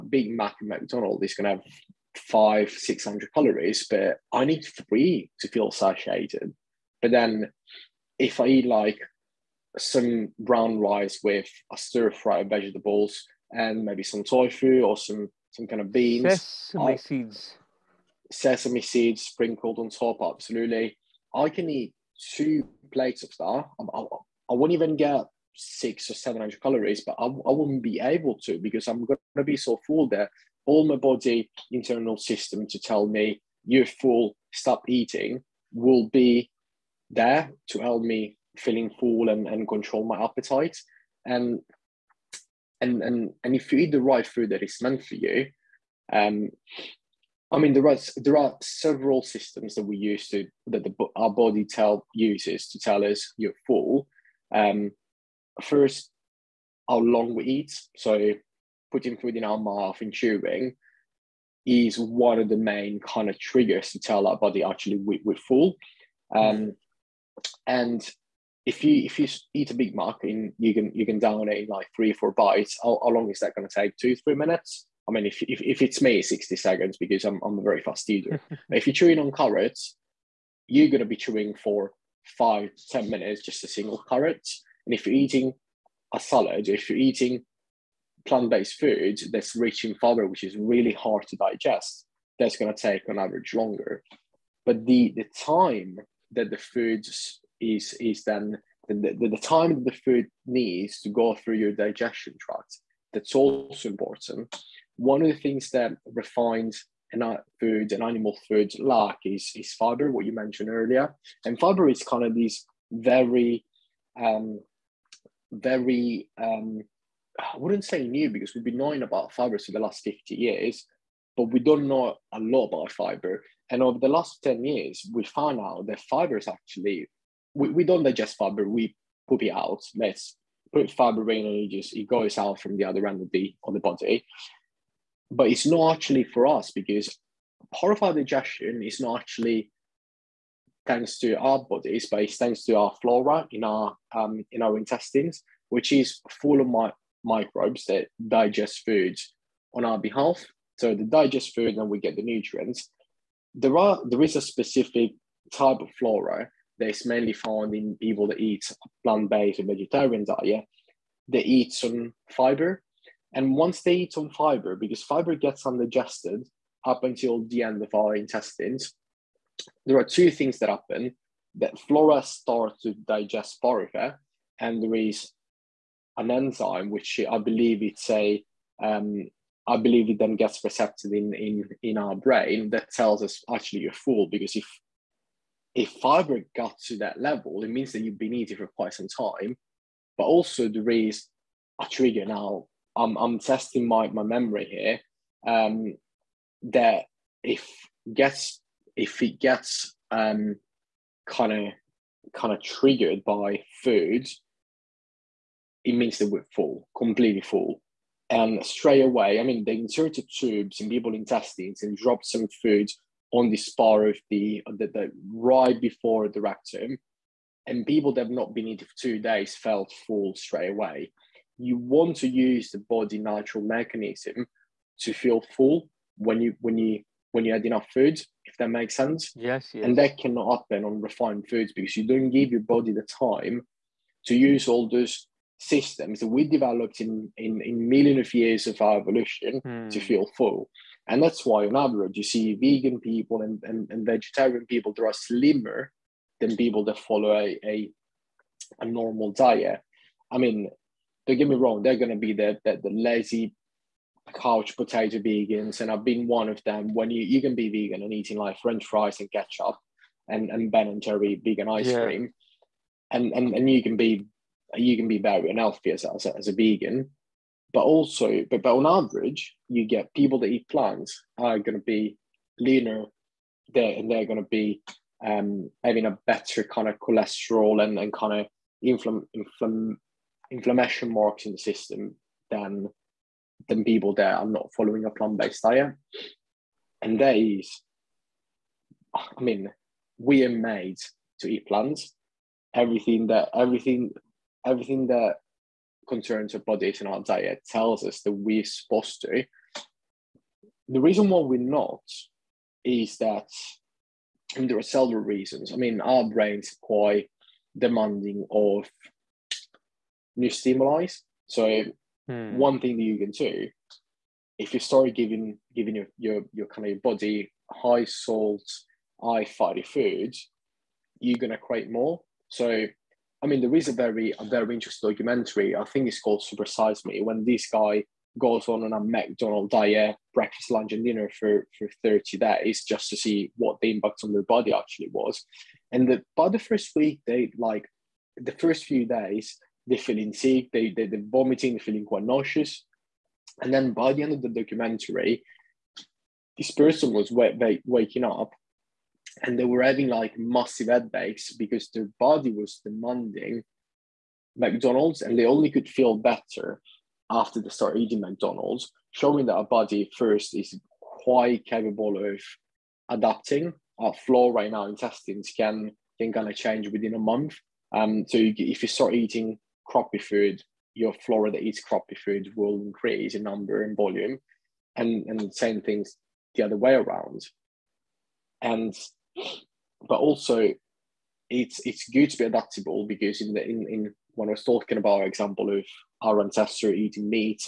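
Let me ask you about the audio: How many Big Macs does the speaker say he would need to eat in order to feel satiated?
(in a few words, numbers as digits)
3.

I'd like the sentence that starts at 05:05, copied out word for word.
I mean, our brains are quite demanding of new stimuli.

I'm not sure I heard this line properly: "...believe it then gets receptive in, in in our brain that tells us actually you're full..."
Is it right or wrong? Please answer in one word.
right.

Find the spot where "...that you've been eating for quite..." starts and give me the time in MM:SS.
03:07.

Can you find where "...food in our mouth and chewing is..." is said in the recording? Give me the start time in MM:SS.
00:59.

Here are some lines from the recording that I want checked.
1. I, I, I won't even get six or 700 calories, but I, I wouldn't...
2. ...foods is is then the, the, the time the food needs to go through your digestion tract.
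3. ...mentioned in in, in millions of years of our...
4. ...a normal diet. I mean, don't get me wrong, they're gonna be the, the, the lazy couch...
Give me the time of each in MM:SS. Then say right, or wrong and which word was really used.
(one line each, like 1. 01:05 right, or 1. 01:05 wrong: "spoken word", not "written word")
1. 00:23 right
2. 01:36 right
3. 03:56 wrong: "developed", not "mentioned"
4. 04:08 right.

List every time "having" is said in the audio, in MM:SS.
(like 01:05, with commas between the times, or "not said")
04:35, 05:49.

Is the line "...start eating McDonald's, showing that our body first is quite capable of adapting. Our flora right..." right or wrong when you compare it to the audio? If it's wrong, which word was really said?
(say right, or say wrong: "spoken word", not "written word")
right.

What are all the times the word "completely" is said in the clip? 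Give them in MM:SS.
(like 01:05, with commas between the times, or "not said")
03:26.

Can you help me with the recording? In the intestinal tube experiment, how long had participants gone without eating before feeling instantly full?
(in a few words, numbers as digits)
2 days.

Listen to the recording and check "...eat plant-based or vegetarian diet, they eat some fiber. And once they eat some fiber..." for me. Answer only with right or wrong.
right.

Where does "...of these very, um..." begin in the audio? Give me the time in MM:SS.
01:52.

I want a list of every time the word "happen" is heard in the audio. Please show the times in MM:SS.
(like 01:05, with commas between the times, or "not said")
02:50, 03:50.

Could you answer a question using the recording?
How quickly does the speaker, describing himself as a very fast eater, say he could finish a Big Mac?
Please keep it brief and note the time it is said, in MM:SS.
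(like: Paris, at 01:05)
60 seconds, at 01:16.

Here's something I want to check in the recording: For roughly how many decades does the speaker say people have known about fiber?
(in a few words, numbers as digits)
50 years.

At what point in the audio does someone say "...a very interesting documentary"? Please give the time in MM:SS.
05:24.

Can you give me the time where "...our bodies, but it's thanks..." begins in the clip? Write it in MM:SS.
02:21.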